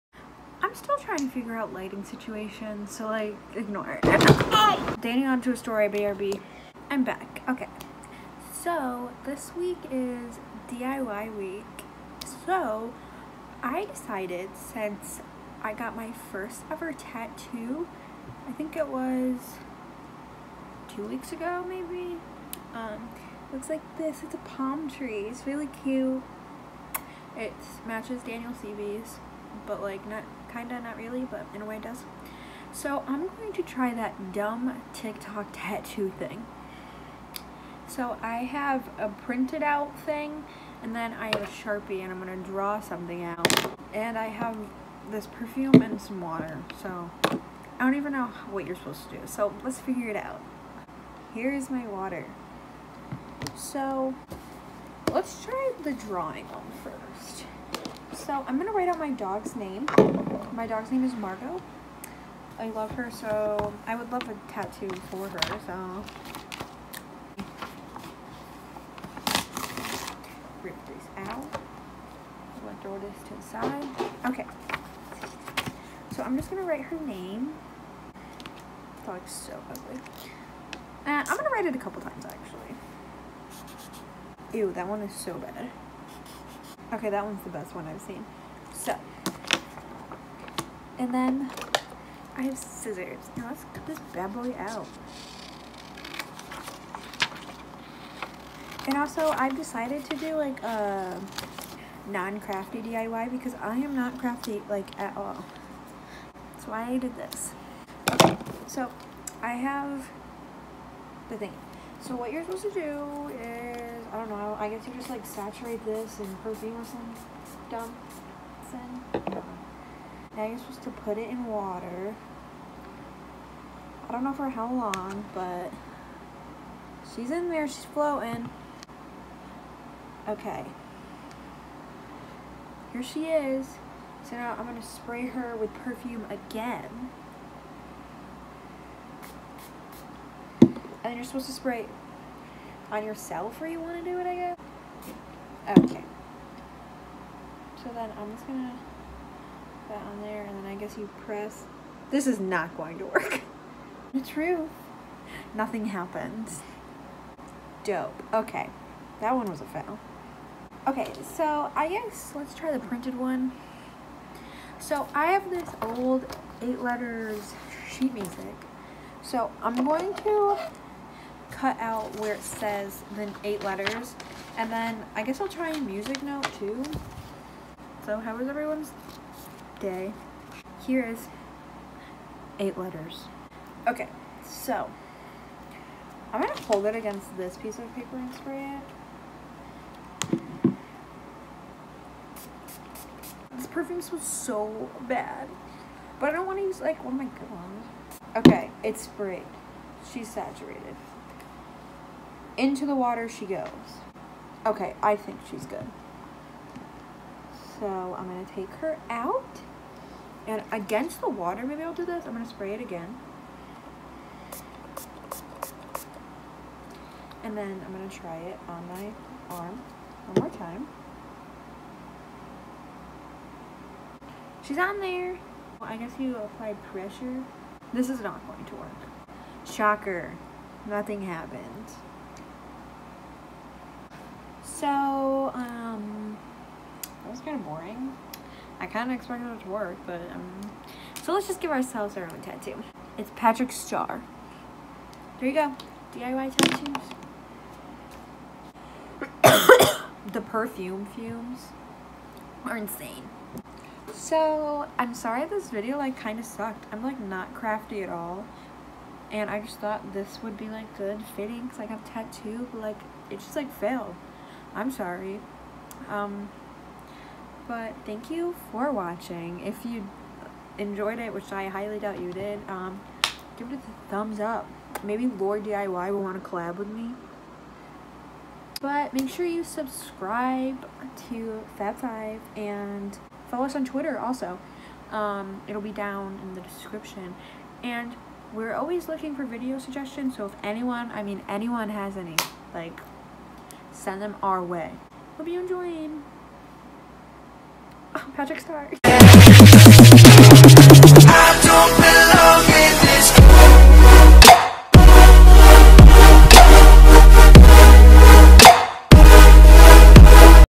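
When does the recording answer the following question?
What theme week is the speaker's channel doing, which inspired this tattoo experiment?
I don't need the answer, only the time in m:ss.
0:10.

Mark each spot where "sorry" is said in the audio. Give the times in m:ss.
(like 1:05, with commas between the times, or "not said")
4:15, 4:24.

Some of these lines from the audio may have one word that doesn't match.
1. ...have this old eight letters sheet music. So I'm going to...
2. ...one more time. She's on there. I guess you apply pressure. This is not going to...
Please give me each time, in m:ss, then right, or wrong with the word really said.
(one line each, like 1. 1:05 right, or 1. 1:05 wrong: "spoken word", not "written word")
1. 2:45 right
2. 3:40 right.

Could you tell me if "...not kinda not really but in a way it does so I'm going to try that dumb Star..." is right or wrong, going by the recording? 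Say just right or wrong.
wrong.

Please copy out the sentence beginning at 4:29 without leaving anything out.
If you enjoyed it, which I highly doubt you did, um, give it a thumbs up.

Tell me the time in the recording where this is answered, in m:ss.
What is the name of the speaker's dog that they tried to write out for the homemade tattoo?
1:01.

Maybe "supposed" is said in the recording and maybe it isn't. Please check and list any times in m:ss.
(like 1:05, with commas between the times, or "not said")
0:48, 1:52, 2:00, 2:21.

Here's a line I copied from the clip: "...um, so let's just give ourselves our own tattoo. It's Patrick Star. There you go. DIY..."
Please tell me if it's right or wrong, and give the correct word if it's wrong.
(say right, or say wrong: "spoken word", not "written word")
right.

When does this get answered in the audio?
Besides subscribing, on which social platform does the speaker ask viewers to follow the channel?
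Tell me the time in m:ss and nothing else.
4:43.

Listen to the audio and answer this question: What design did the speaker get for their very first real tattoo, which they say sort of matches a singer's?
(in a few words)
Palm tree.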